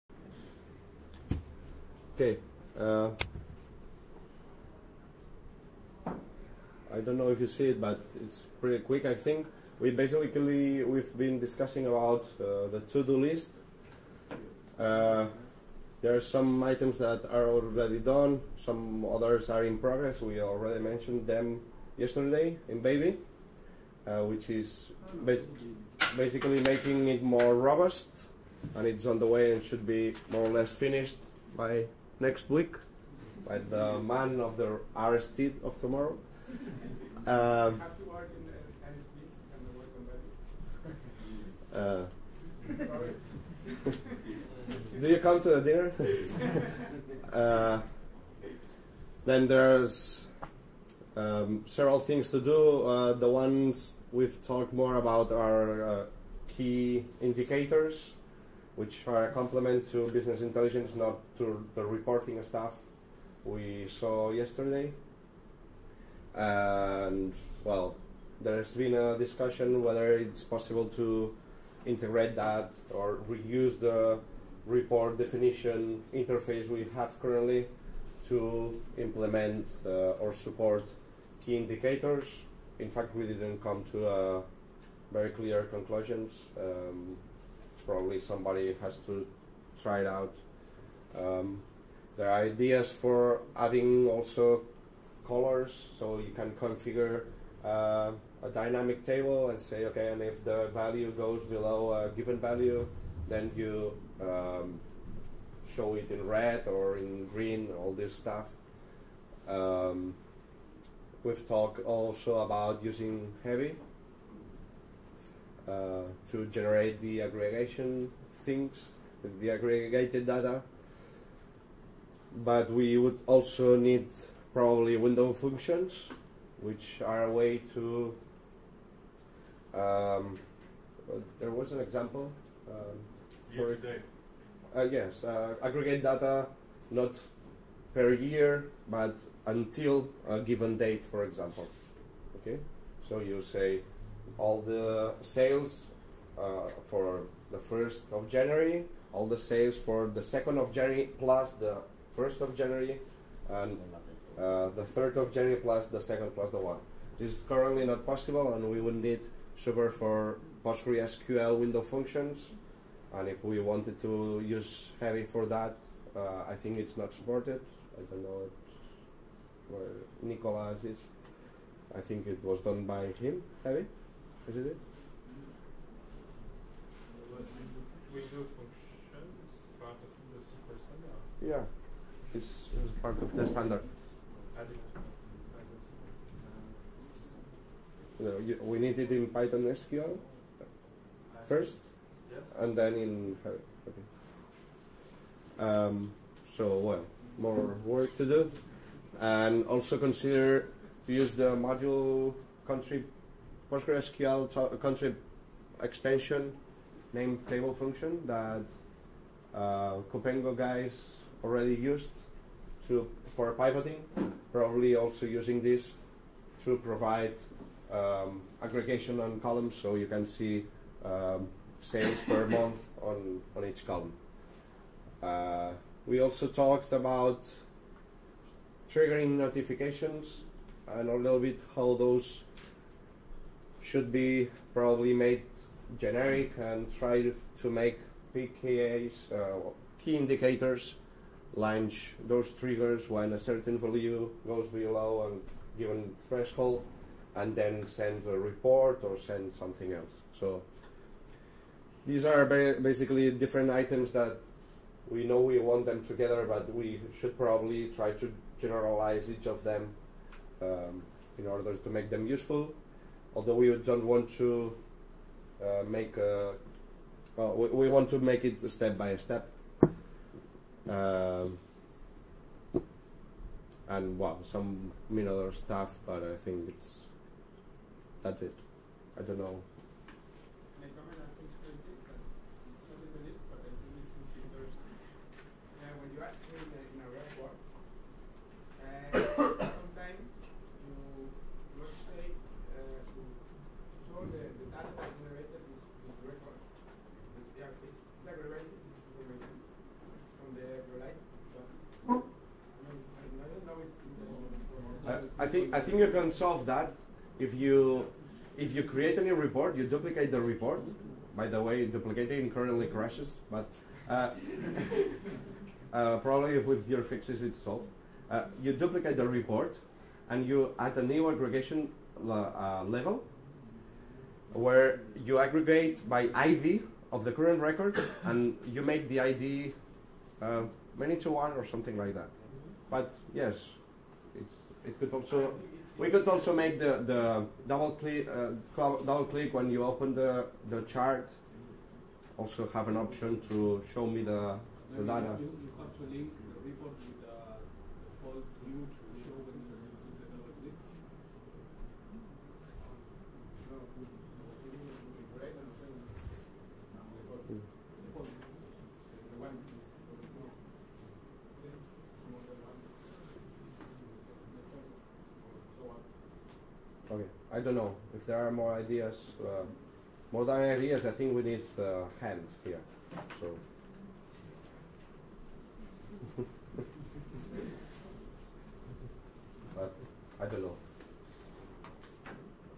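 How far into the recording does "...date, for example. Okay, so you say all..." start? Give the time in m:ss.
2:20.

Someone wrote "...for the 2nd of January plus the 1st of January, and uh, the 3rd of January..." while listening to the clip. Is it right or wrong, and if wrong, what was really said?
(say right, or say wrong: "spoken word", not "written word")
right.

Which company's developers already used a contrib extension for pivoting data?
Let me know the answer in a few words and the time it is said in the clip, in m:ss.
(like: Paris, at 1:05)
Coopengo, at 3:30.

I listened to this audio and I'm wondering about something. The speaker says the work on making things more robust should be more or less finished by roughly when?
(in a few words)
next week.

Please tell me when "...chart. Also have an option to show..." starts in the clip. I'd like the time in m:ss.
5:40.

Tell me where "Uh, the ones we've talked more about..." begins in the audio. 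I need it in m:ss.
0:52.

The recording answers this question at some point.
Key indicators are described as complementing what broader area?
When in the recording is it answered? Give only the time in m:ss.
1:00.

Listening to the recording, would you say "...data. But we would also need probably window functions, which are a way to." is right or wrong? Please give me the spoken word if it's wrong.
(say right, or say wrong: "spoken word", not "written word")
right.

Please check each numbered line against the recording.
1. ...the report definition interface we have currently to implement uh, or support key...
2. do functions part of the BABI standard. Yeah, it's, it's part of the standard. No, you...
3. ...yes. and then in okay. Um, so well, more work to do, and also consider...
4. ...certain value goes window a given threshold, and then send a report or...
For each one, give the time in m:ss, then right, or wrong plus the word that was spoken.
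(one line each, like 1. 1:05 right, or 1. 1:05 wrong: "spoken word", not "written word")
1. 1:13 right
2. 2:58 wrong: "SQL", not "BABI"
3. 3:12 right
4. 4:03 wrong: "below", not "window".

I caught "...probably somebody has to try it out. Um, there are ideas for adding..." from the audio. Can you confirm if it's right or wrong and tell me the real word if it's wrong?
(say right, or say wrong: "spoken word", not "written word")
right.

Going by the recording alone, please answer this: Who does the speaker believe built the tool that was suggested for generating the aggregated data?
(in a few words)
Nicolas.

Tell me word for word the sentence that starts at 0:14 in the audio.
Uh, there are some items that are already done, some others are in progress.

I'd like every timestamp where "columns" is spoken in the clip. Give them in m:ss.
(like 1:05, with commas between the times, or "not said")
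3:39, 3:43.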